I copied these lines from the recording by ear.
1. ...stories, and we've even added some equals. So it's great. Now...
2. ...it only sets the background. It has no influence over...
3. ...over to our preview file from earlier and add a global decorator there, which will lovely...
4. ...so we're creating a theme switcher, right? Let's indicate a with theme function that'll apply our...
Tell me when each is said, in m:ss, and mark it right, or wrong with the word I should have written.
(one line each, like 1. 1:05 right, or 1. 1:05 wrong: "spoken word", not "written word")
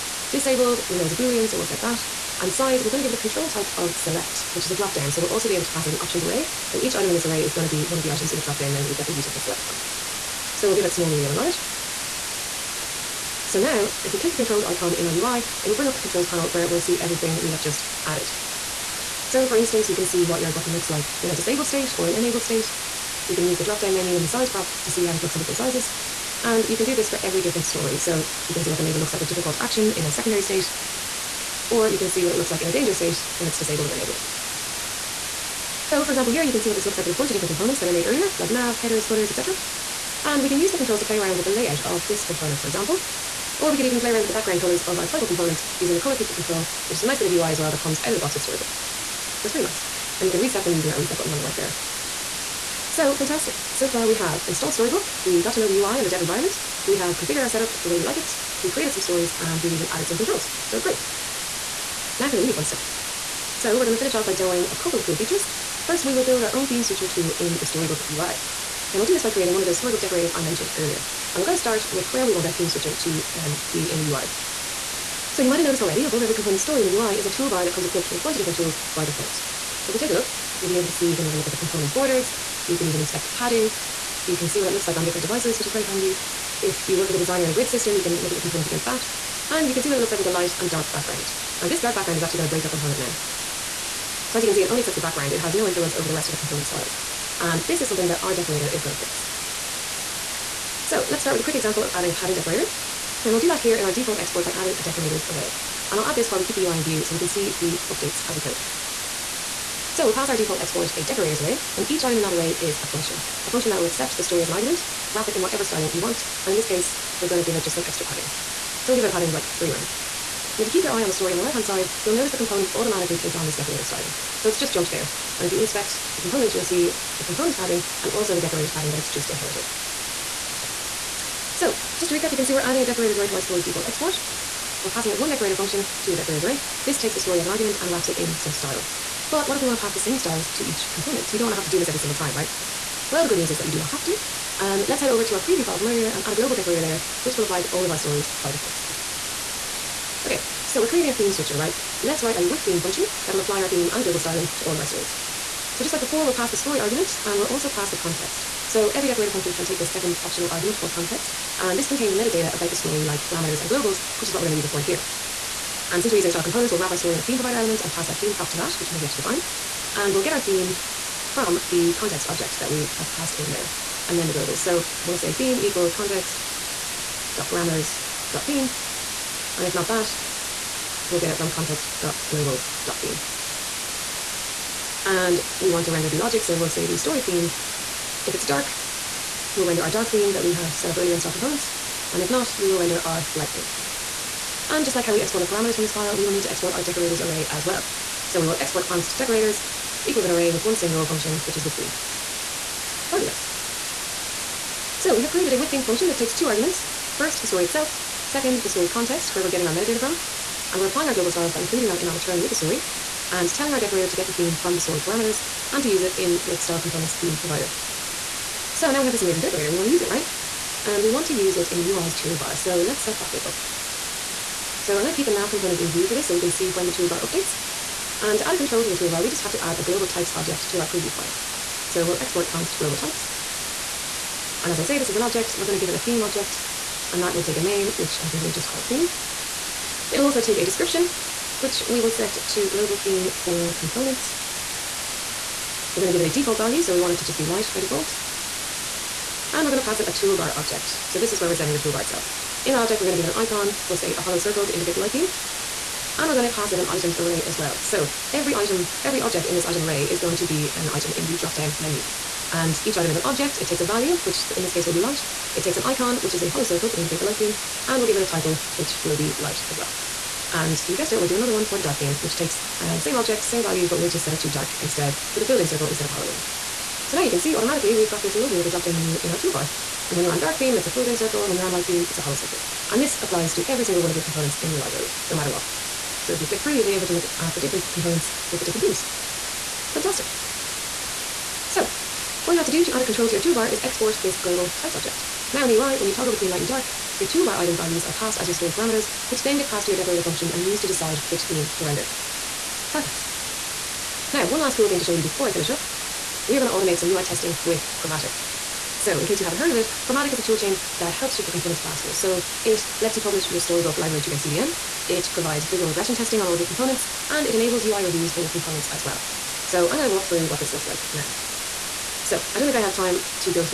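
1. 0:59 wrong: "controls", not "equals"
2. 1:34 right
3. 2:25 wrong: "apply", not "lovely"
4. 2:30 wrong: "write", not "indicate".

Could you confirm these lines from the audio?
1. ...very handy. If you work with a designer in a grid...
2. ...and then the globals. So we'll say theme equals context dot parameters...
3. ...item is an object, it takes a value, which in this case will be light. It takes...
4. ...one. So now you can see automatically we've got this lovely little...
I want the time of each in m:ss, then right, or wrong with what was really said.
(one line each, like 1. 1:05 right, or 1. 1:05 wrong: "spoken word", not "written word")
1. 1:25 right
2. 2:54 right
3. 4:22 right
4. 4:36 right.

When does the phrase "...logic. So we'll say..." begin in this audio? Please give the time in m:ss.
3:06.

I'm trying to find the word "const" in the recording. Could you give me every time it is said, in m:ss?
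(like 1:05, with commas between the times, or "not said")
3:18, 3:52.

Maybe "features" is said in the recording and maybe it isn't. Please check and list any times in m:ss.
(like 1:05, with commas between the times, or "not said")
1:05.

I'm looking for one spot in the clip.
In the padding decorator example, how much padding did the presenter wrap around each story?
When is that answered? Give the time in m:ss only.
1:59.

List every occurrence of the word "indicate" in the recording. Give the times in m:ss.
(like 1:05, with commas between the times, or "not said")
4:14, 4:26.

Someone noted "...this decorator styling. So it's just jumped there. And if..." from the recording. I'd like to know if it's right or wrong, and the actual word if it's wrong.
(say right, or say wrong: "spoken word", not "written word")
right.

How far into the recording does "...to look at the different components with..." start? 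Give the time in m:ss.
4:47.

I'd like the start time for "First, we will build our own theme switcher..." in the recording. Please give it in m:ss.
1:05.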